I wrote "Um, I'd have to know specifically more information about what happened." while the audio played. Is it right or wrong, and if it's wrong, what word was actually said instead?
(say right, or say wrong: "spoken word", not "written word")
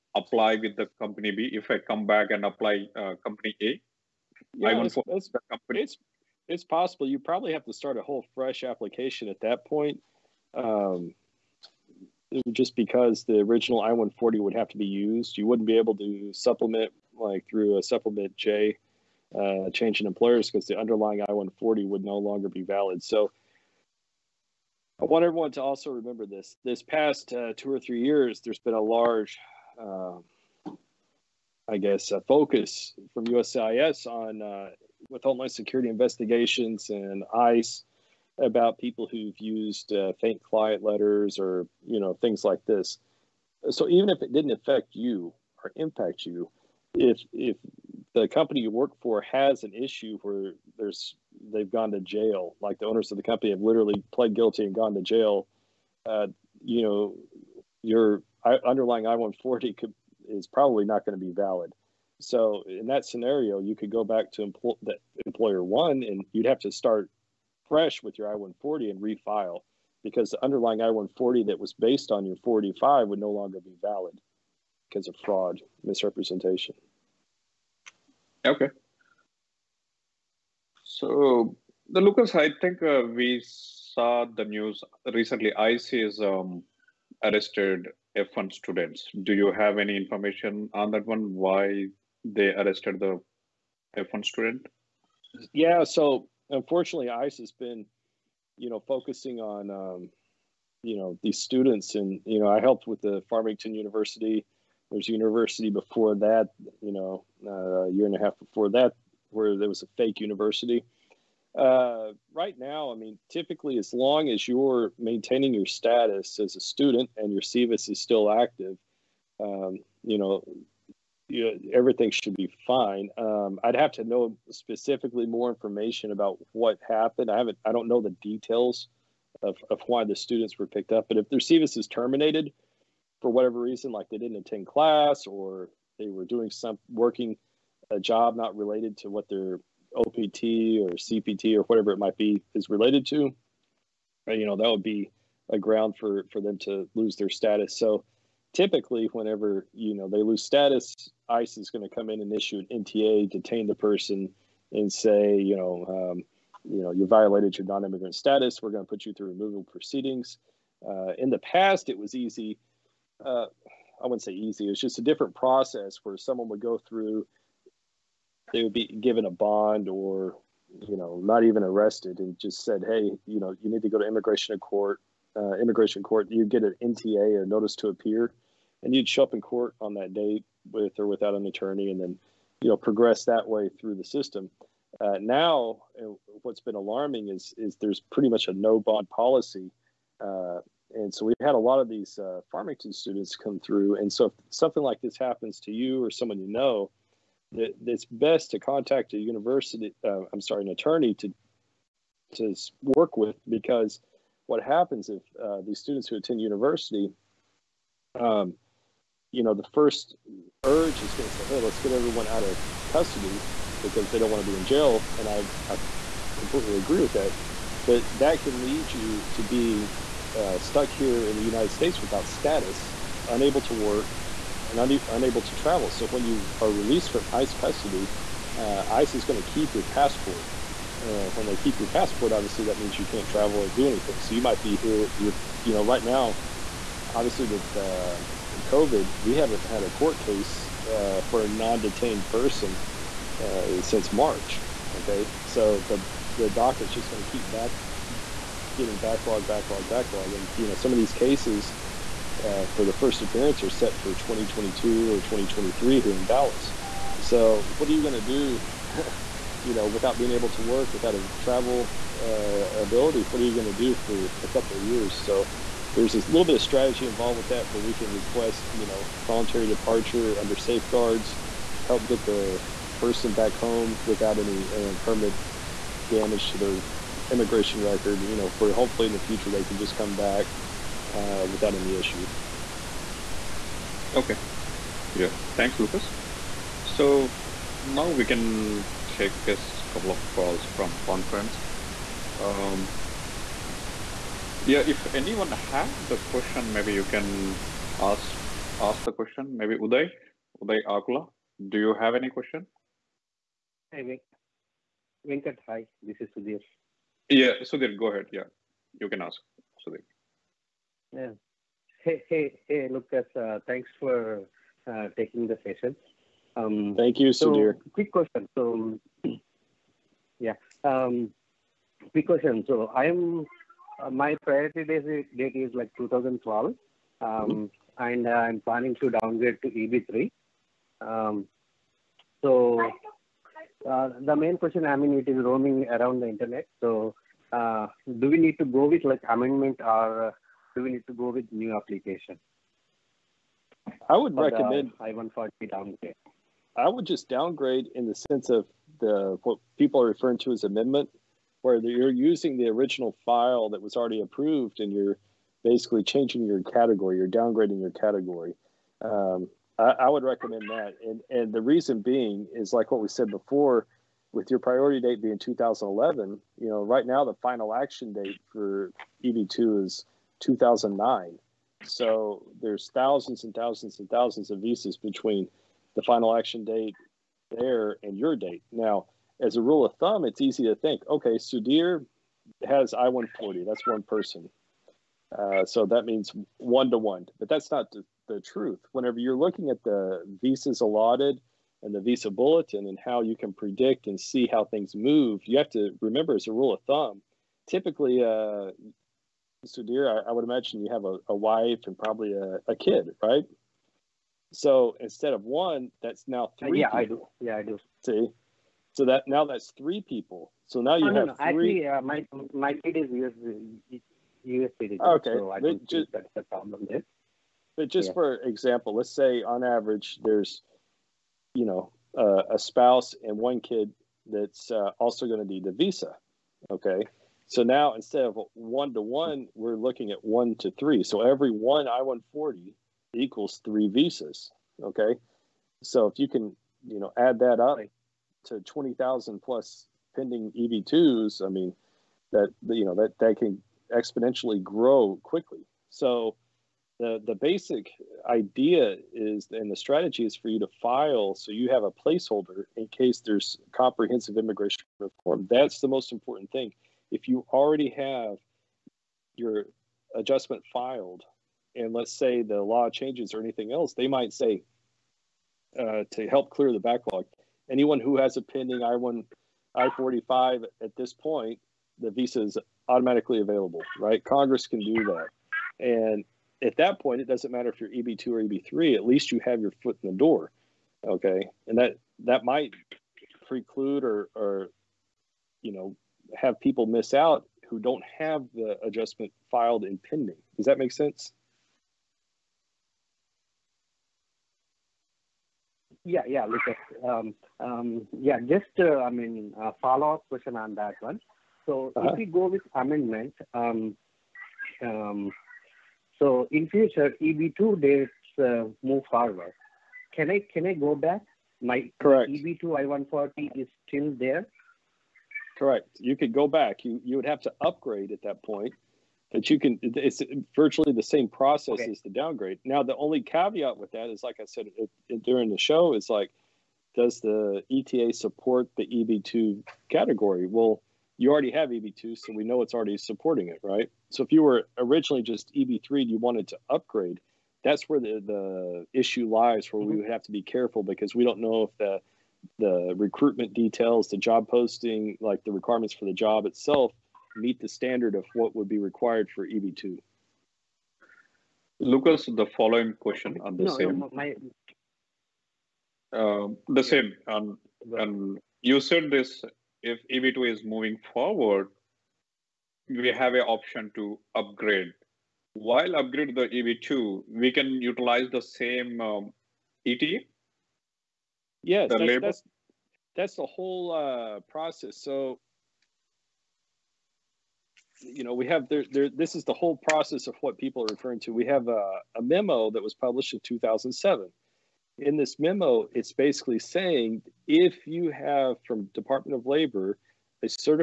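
right.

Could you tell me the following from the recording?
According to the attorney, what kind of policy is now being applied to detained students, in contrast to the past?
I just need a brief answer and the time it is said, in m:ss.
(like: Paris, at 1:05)
No bond policy, at 3:08.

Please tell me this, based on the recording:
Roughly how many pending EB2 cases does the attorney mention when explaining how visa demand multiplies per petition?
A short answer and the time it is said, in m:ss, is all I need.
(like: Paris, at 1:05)
20,000, at 7:18.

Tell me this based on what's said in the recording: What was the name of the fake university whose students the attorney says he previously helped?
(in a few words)
Farmington University.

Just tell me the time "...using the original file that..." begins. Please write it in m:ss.
5:52.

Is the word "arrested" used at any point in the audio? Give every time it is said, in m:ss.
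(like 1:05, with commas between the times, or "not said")
1:27, 1:32, 2:51.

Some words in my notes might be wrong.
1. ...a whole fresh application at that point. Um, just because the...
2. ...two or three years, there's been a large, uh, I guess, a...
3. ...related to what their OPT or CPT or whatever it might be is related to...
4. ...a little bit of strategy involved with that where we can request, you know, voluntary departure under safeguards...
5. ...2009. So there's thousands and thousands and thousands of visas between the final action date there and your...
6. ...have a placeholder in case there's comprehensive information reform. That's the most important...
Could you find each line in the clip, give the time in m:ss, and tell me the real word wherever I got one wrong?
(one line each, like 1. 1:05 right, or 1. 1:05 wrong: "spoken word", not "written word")
1. 0:07 right
2. 0:27 right
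3. 2:18 right
4. 4:26 right
5. 6:10 right
6. 7:31 wrong: "immigration", not "information".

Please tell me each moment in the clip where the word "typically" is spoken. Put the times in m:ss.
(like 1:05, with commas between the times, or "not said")
1:53, 2:28, 6:37.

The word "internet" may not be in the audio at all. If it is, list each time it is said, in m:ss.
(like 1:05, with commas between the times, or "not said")
5:36.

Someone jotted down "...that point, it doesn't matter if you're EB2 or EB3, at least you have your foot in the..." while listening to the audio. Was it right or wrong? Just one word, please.
right.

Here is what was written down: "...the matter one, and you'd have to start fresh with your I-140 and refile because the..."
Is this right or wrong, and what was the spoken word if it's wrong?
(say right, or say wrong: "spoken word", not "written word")
wrong: "employer", not "matter".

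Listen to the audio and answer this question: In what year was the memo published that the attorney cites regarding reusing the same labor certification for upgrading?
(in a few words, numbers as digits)
2007.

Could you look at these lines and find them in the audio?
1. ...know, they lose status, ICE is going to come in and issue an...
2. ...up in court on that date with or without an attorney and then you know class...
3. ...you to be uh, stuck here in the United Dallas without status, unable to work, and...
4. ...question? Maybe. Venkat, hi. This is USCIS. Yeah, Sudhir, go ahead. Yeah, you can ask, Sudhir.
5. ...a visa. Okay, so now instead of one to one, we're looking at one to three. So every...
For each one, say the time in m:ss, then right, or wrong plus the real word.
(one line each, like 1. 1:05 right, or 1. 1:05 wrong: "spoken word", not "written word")
1. 2:29 right
2. 2:59 wrong: "progress", not "class"
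3. 3:38 wrong: "States", not "Dallas"
4. 5:02 wrong: "Sudhir", not "USCIS"
5. 7:05 right.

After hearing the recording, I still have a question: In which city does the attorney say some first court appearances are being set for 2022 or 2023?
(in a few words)
Dallas.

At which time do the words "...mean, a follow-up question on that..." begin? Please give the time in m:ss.
8:19.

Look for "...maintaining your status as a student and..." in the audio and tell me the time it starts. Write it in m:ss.
1:54.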